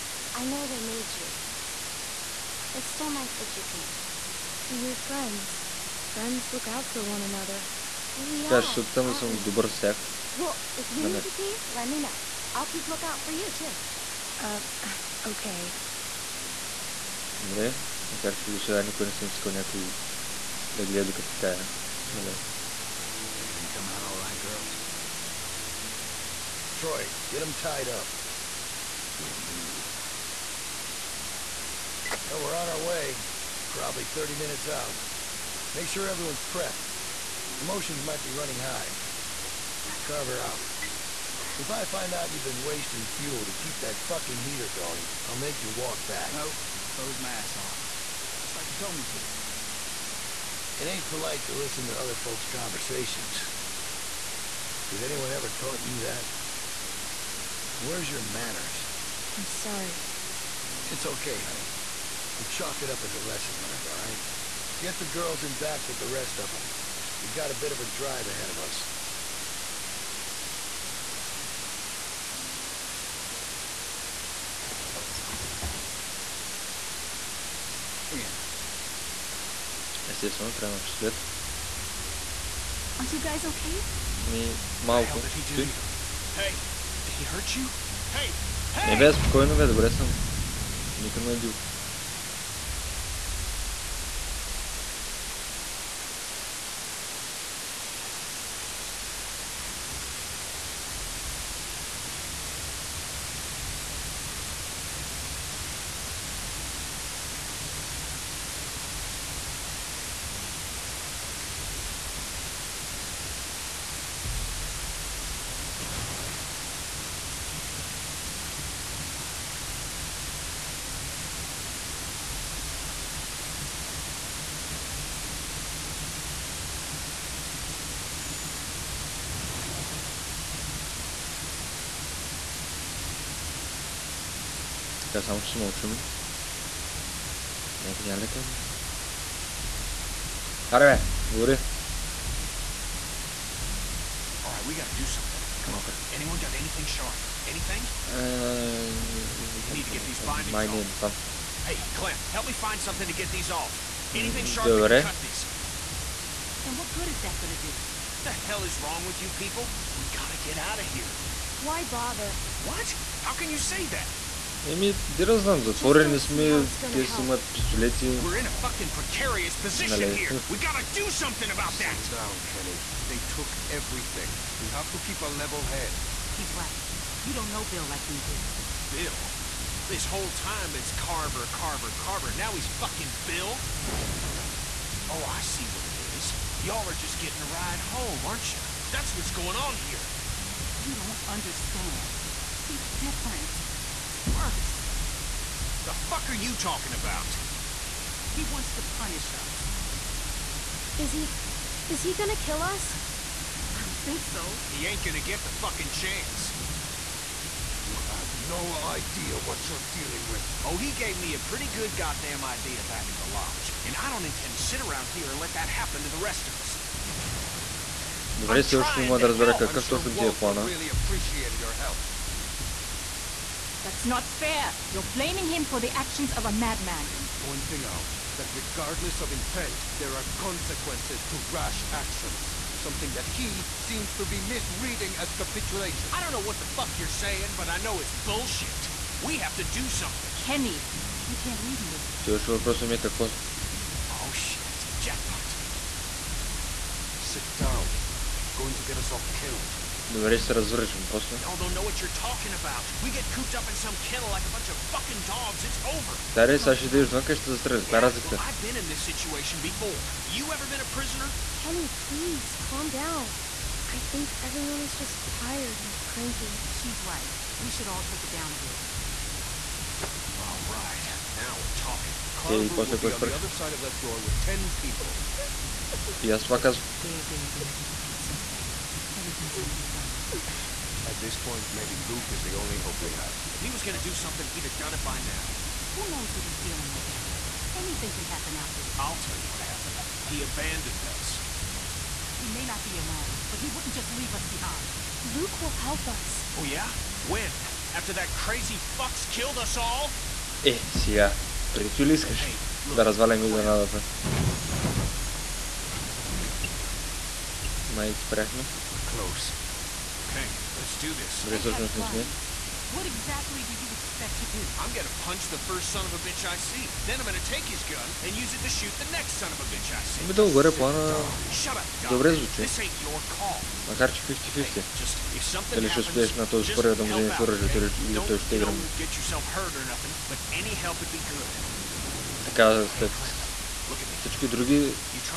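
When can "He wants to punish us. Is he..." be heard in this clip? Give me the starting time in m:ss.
3:18.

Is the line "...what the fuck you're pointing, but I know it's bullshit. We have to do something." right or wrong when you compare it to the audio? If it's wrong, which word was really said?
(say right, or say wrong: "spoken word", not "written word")
wrong: "saying", not "pointing".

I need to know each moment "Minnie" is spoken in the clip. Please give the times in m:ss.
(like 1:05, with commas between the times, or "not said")
not said.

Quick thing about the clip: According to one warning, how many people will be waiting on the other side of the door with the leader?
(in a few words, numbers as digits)
10.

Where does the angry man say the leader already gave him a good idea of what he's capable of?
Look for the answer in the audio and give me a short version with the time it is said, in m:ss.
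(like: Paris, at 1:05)
the lodge, at 3:33.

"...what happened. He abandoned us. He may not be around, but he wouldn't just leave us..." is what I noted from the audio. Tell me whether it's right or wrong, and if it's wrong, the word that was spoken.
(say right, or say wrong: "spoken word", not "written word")
right.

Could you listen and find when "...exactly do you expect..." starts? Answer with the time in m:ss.
5:13.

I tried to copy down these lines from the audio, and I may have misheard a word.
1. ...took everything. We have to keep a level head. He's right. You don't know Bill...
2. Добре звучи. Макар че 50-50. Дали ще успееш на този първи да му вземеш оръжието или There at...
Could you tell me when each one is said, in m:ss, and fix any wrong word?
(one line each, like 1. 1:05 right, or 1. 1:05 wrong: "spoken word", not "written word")
1. 2:53 right
2. 5:24 wrong: "Look", not "There".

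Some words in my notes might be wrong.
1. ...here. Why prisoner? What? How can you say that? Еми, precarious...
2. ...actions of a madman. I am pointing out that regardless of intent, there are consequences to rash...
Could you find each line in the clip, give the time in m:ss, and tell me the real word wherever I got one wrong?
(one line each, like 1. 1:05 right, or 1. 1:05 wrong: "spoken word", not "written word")
1. 2:40 wrong: "bother", not "prisoner"
2. 3:45 right.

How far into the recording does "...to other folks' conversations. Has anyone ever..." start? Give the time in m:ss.
0:51.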